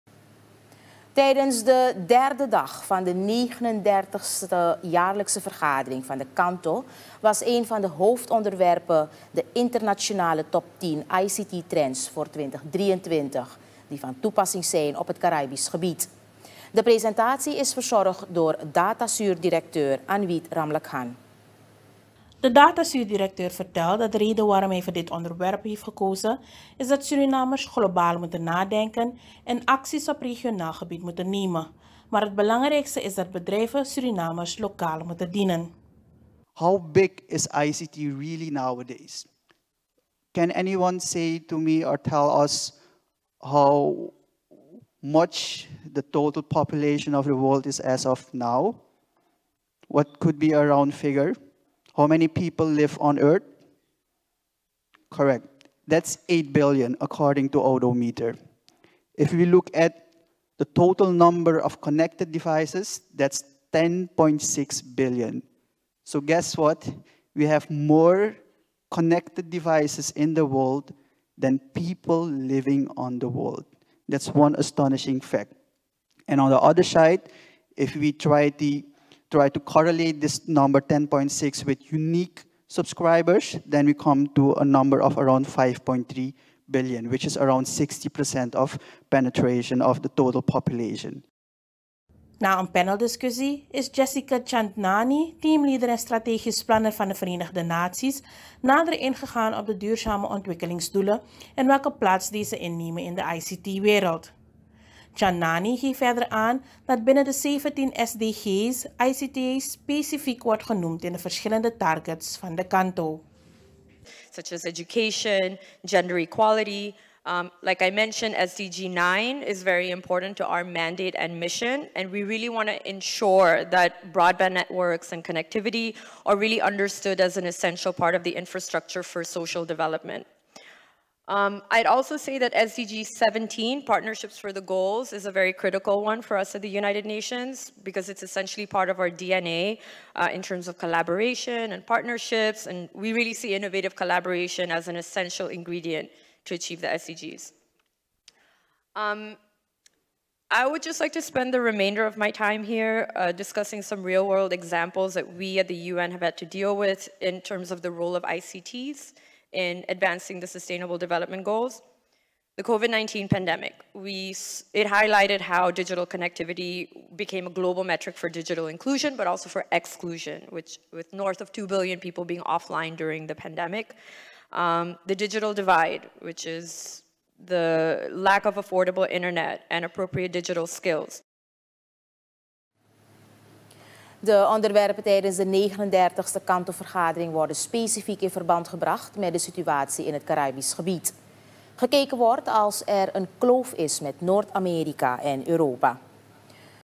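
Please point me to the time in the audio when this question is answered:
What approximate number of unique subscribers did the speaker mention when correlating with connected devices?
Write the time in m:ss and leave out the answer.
1:25.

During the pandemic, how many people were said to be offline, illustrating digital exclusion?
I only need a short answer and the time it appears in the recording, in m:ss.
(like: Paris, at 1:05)
north of 2 billion, at 2:51.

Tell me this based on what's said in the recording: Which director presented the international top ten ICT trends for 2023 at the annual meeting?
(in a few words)
Anwit Ramlakhan.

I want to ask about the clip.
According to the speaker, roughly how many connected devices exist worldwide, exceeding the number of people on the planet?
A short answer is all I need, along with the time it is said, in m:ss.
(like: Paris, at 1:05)
10.6 billion, at 1:03.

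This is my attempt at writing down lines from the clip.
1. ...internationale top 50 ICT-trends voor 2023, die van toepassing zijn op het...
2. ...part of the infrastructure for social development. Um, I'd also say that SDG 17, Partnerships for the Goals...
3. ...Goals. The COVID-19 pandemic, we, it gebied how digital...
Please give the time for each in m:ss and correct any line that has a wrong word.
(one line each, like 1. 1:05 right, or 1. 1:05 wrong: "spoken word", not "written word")
1. 0:09 wrong: "10", not "50"
2. 2:07 right
3. 2:41 wrong: "highlighted", not "gebied".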